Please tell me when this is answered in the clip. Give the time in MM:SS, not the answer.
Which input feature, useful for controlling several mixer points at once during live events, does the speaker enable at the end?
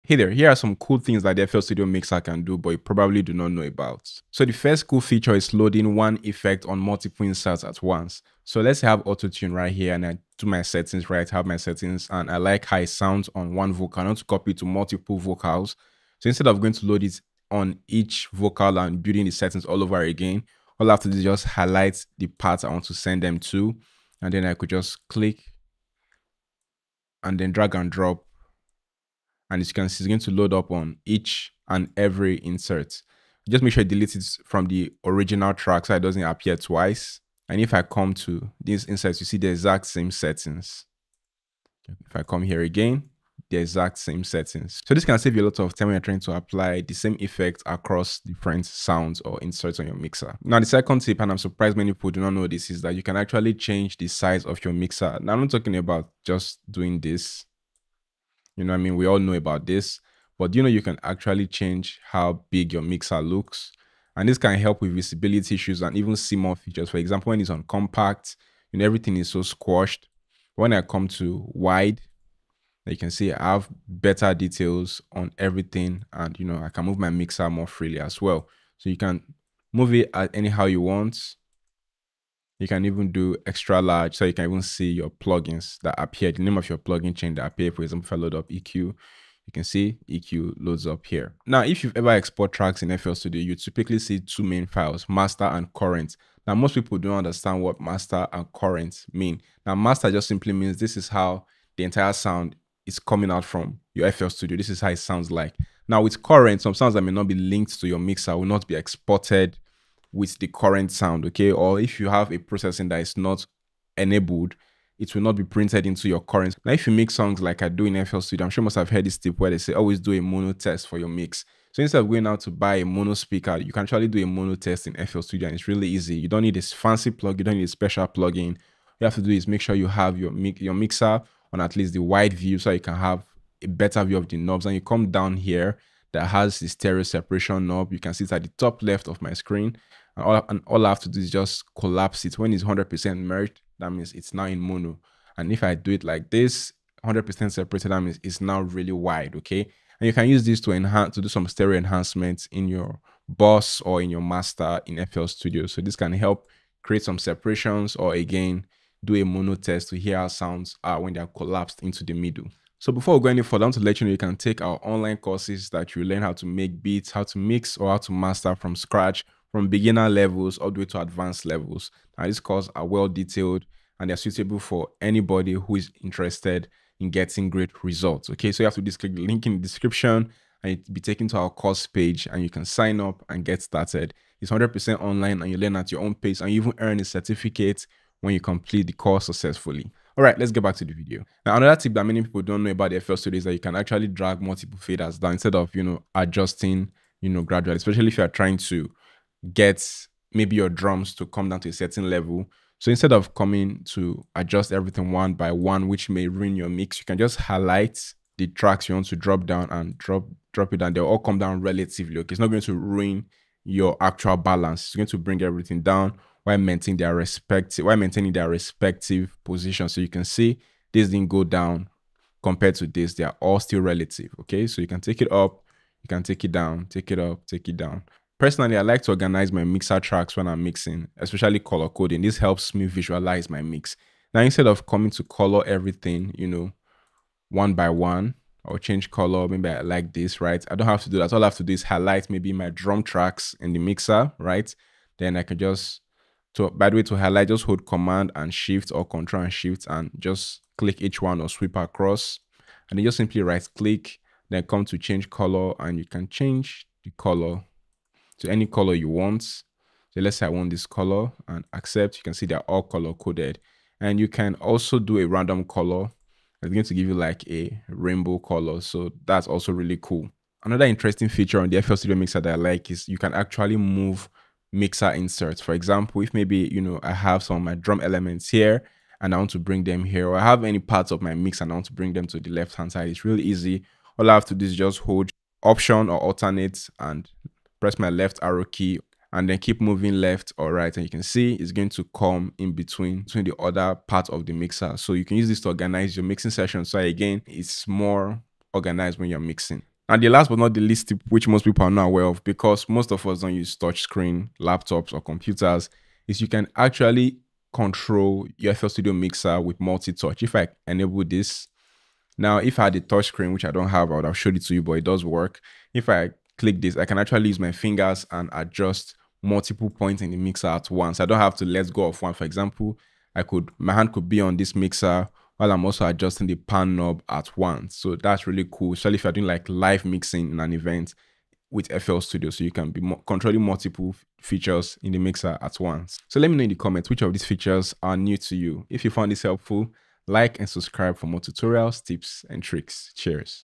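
05:09.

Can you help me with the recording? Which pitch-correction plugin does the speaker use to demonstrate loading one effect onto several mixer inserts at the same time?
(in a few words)
Auto-tune.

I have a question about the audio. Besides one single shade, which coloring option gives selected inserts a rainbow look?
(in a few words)
Random color.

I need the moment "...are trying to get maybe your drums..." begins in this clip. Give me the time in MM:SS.
03:18.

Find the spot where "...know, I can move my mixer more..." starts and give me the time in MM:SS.
01:16.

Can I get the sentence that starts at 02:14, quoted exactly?
And you come down here that has the stereo separation knob.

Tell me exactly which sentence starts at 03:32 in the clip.
Okay, it's not going to ruin your actual balance.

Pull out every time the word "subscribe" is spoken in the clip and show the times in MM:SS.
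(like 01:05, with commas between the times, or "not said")
05:40.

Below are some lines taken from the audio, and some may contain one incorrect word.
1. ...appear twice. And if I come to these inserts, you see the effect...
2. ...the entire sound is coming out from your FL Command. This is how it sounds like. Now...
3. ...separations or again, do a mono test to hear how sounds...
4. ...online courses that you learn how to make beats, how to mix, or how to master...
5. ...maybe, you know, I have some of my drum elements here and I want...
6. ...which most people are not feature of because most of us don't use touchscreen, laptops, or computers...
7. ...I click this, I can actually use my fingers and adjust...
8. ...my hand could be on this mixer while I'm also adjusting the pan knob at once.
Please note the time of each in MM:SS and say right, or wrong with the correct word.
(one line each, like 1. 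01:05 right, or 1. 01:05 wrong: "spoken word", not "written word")
1. 00:36 wrong: "exact", not "effect"
2. 01:41 wrong: "Studio", not "Command"
3. 02:37 right
4. 02:44 right
5. 04:36 right
6. 05:01 wrong: "aware", not "feature"
7. 05:16 right
8. 05:23 right.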